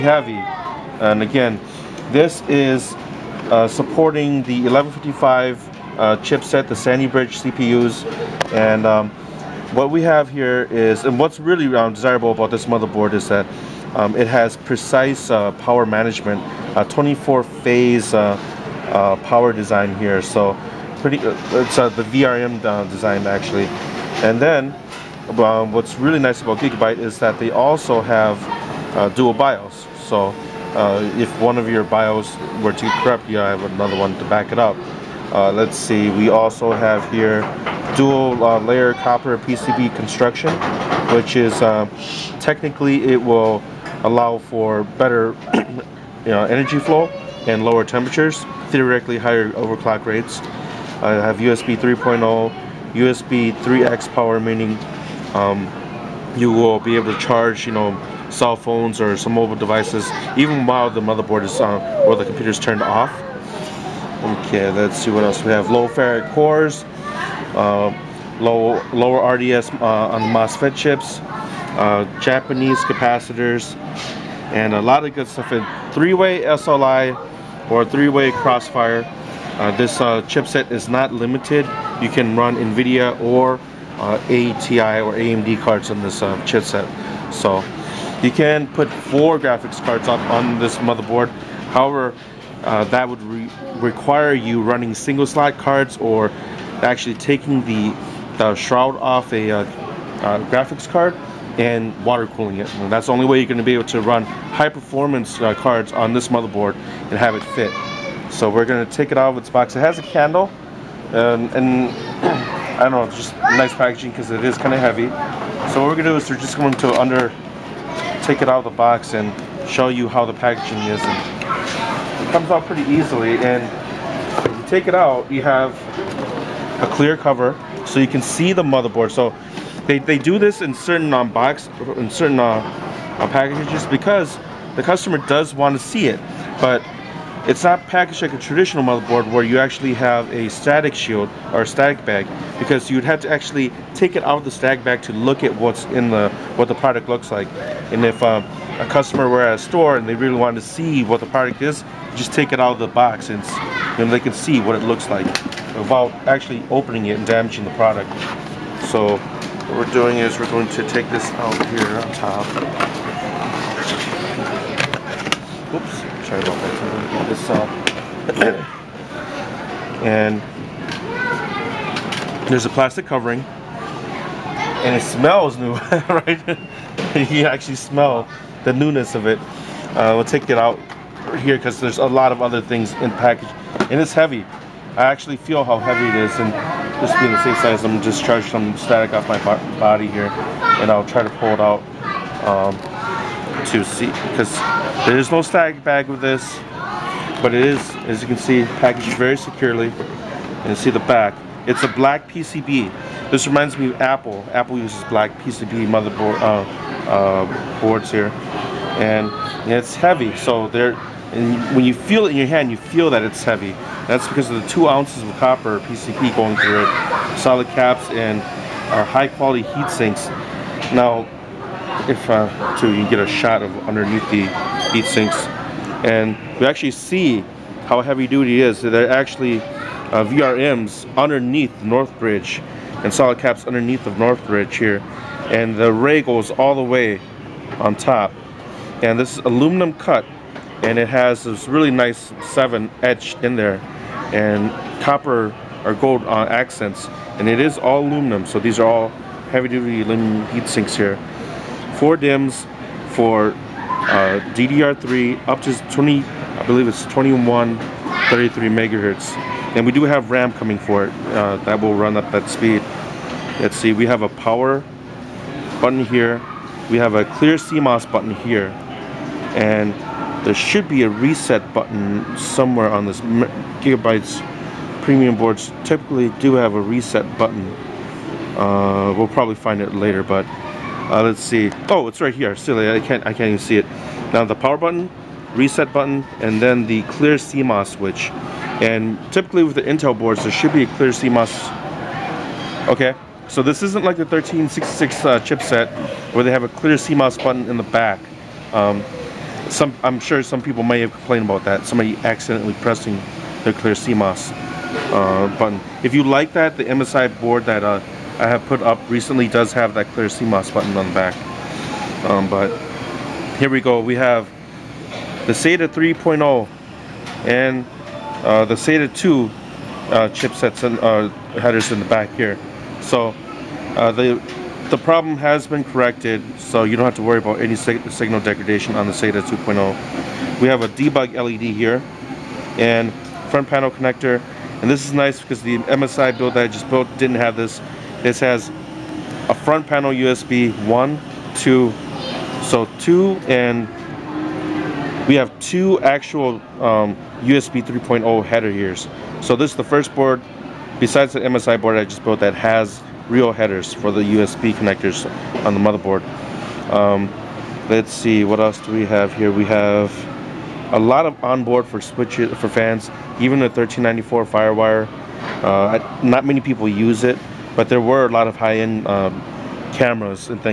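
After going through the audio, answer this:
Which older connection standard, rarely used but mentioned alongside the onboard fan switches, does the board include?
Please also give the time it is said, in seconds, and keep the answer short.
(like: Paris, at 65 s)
1394 Firewire, at 363 s.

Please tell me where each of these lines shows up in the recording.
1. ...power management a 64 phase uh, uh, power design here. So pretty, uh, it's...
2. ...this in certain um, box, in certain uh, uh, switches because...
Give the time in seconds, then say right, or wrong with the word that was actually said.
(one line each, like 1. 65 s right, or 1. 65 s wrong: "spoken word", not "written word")
1. 15 s wrong: "24", not "64"
2. 130 s wrong: "packages", not "switches".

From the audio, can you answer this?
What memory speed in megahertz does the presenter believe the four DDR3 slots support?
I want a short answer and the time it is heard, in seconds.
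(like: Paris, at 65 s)
2133, at 257 s.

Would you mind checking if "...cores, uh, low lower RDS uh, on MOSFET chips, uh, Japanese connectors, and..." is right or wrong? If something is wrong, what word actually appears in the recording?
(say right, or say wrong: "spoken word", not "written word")
wrong: "capacitors", not "connectors".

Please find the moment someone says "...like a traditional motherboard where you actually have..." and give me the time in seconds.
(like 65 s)
138 s.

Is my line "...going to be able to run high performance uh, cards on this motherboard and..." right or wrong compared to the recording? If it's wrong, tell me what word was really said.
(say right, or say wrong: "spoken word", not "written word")
right.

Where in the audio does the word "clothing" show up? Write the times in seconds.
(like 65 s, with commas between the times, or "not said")
not said.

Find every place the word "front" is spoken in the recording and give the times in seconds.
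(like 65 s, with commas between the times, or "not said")
333 s, 339 s.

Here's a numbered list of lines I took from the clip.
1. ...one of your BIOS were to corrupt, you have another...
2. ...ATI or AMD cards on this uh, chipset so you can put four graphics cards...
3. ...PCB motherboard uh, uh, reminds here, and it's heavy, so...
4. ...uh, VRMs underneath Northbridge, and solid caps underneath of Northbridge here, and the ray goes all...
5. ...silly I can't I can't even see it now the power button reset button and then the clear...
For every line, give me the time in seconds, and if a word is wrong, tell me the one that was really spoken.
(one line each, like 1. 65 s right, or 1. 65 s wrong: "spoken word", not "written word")
1. 31 s right
2. 84 s right
3. 205 s wrong: "boards", not "reminds"
4. 229 s right
5. 282 s right.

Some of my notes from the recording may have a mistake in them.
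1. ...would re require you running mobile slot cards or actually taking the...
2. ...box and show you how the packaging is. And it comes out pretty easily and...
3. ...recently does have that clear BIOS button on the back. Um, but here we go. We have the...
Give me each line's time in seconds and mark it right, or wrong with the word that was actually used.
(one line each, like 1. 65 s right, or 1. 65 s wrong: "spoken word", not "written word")
1. 93 s wrong: "single", not "mobile"
2. 118 s right
3. 309 s wrong: "CMOS", not "BIOS".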